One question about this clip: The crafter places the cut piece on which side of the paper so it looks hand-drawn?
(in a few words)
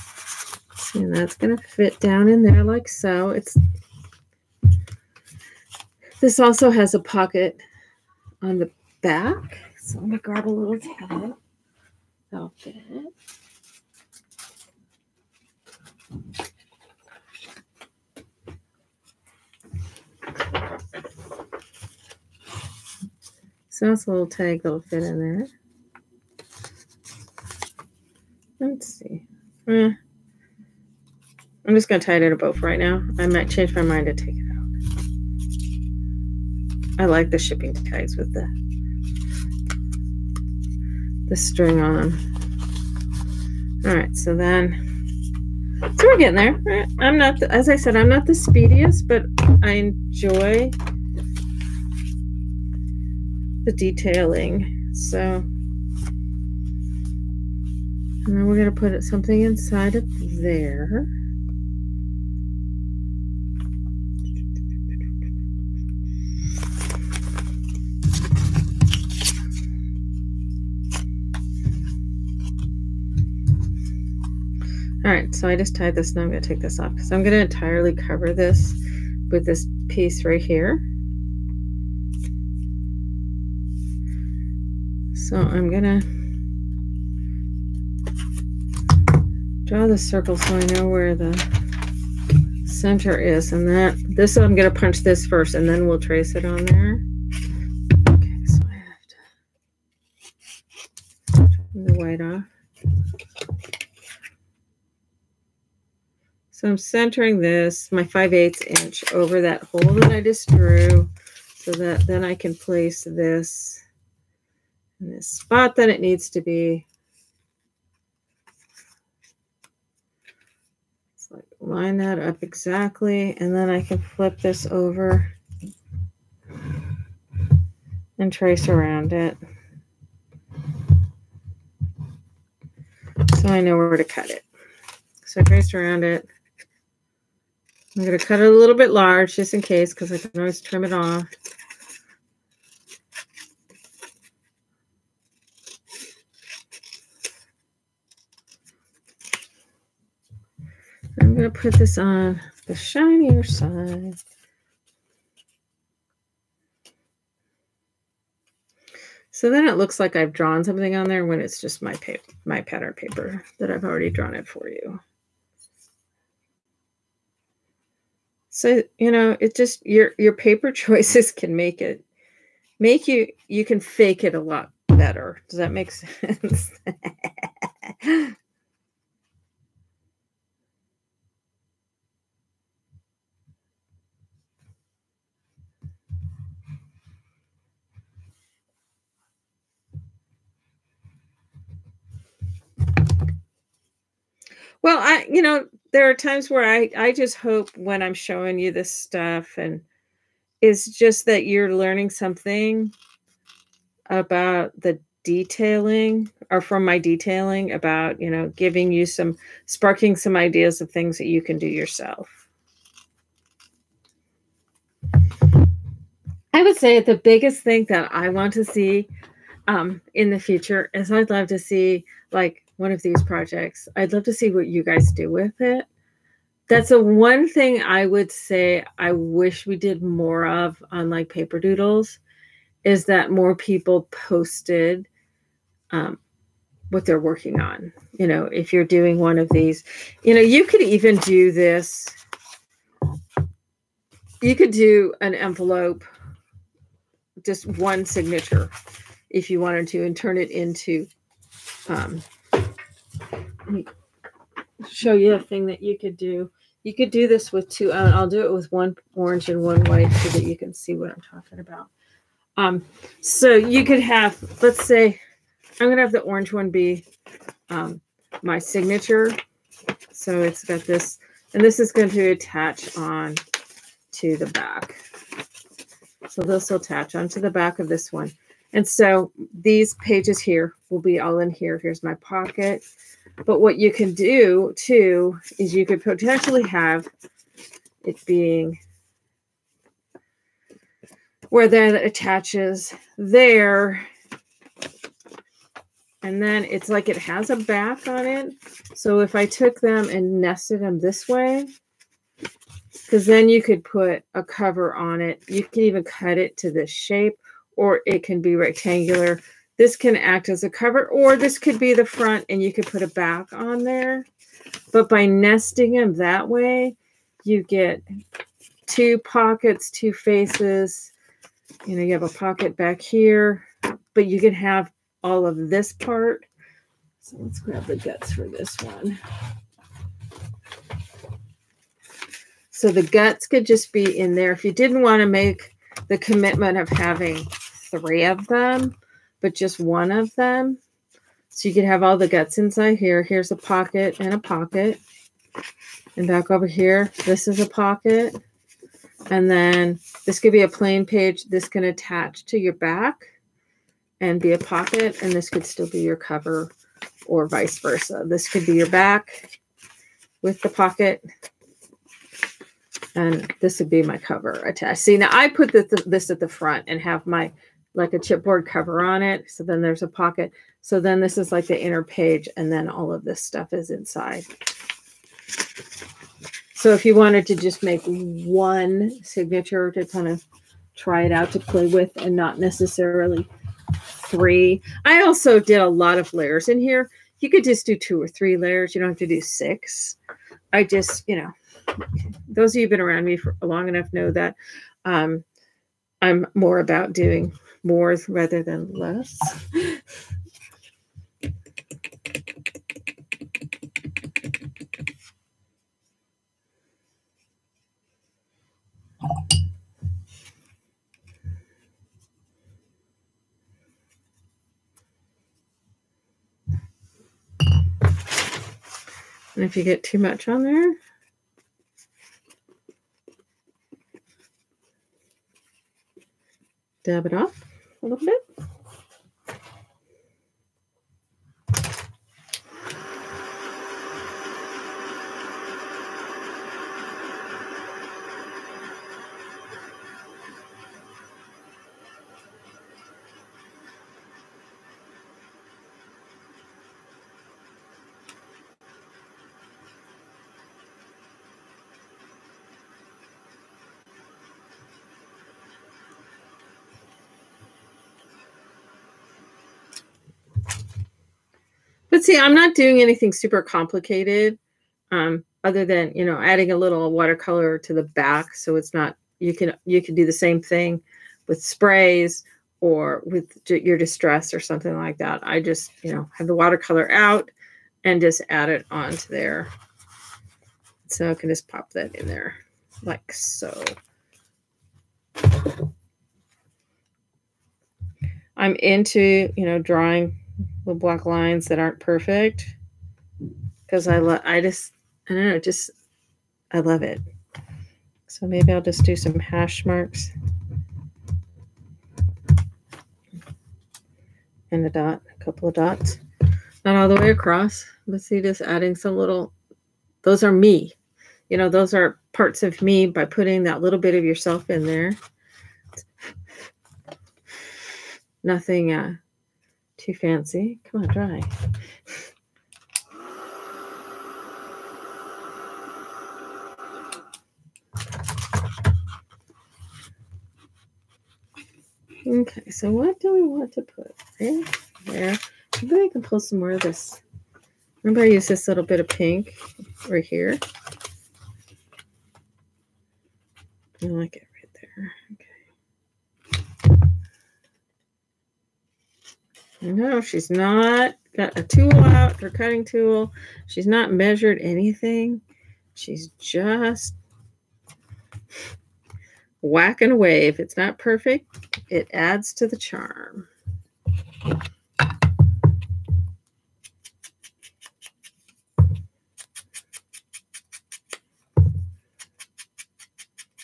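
The shinier side.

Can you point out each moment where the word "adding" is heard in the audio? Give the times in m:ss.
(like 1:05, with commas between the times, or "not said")
7:46, 8:28.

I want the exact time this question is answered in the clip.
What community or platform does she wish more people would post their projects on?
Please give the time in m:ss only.
3:51.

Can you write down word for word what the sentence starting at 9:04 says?
I like it No, she's not got a tool out, her cutting tool.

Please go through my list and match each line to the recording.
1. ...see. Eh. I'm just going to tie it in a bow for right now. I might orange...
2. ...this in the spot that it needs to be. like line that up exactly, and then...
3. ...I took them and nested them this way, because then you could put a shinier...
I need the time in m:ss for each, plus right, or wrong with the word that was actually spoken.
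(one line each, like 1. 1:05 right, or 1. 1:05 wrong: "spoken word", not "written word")
1. 0:28 wrong: "change", not "orange"
2. 1:53 right
3. 4:59 wrong: "cover", not "shinier".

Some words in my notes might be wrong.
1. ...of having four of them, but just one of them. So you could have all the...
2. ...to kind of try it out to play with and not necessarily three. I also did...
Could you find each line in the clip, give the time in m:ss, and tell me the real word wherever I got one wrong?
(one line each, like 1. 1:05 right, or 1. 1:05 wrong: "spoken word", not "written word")
1. 5:36 wrong: "three", not "four"
2. 6:19 right.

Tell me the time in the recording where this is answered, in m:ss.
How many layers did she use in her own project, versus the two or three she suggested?
6:29.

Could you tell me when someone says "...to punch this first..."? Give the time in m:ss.
1:34.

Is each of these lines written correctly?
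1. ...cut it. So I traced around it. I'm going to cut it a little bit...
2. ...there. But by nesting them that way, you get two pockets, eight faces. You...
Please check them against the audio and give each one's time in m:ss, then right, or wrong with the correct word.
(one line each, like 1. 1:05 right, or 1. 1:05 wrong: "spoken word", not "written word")
1. 2:14 right
2. 5:13 wrong: "two", not "eight".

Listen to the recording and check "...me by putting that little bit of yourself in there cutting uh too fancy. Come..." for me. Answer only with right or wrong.
wrong.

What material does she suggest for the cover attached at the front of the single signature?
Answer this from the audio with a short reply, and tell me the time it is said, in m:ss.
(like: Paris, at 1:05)
Chipboard, at 6:08.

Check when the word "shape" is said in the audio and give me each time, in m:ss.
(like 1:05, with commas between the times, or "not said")
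5:06.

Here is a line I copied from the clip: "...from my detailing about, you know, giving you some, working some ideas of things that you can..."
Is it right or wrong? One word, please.
wrong.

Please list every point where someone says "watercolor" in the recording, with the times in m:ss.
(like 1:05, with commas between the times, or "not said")
7:47, 7:56.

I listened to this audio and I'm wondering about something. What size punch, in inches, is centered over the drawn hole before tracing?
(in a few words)
5/8 inch.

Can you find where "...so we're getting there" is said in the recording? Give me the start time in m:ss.
0:45.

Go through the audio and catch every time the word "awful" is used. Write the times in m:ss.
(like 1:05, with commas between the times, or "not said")
not said.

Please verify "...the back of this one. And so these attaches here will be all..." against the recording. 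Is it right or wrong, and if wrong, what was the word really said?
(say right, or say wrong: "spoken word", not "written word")
wrong: "pages", not "attaches".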